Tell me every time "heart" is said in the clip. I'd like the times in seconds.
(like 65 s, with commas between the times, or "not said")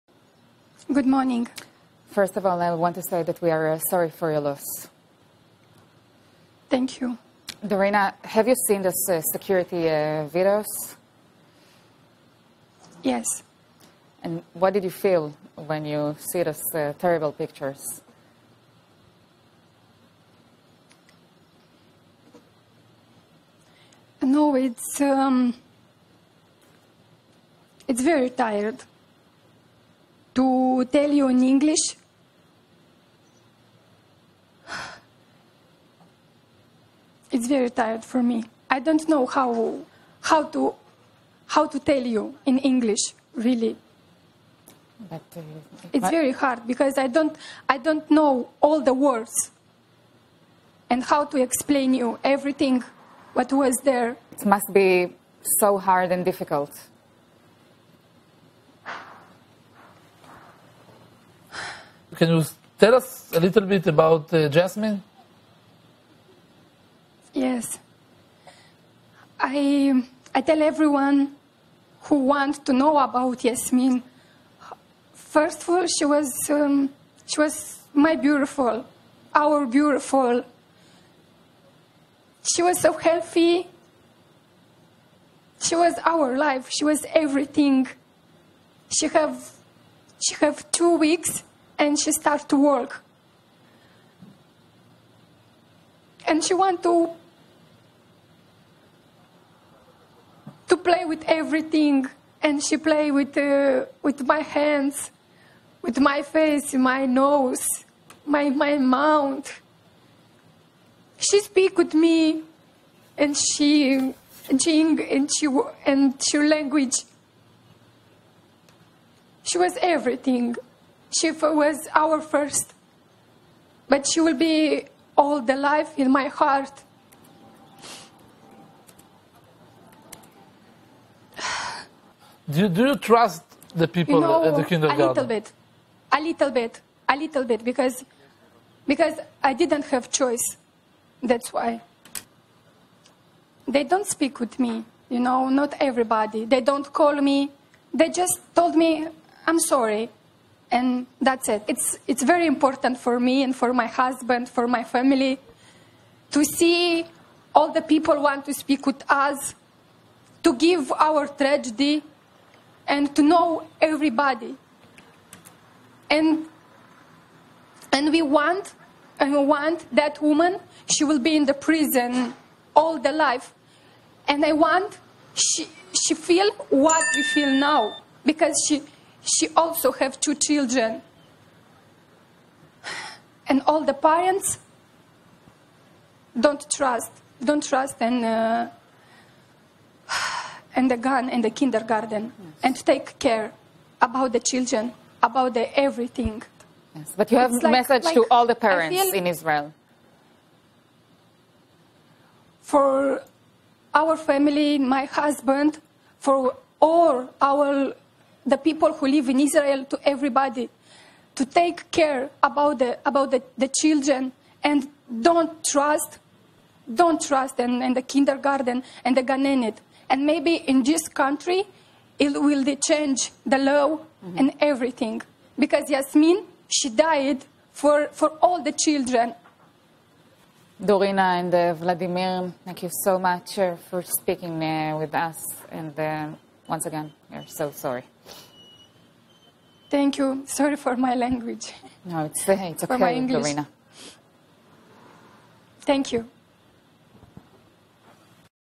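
126 s.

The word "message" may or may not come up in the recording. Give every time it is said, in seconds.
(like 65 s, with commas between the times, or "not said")
197 s.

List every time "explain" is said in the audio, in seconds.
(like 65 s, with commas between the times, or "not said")
51 s.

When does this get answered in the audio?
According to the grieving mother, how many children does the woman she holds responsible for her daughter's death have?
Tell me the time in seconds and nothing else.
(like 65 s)
180 s.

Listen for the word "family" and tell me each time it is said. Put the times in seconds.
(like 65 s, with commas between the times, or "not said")
154 s, 204 s.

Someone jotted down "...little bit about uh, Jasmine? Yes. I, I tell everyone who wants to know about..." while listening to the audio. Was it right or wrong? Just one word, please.
right.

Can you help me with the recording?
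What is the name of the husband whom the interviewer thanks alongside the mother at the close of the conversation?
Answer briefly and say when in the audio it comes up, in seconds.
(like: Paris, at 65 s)
Vladimir, at 231 s.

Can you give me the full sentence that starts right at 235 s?
And uh, once again, we're so sorry.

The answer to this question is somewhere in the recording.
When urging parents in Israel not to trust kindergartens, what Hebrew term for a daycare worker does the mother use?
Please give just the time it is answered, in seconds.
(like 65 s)
219 s.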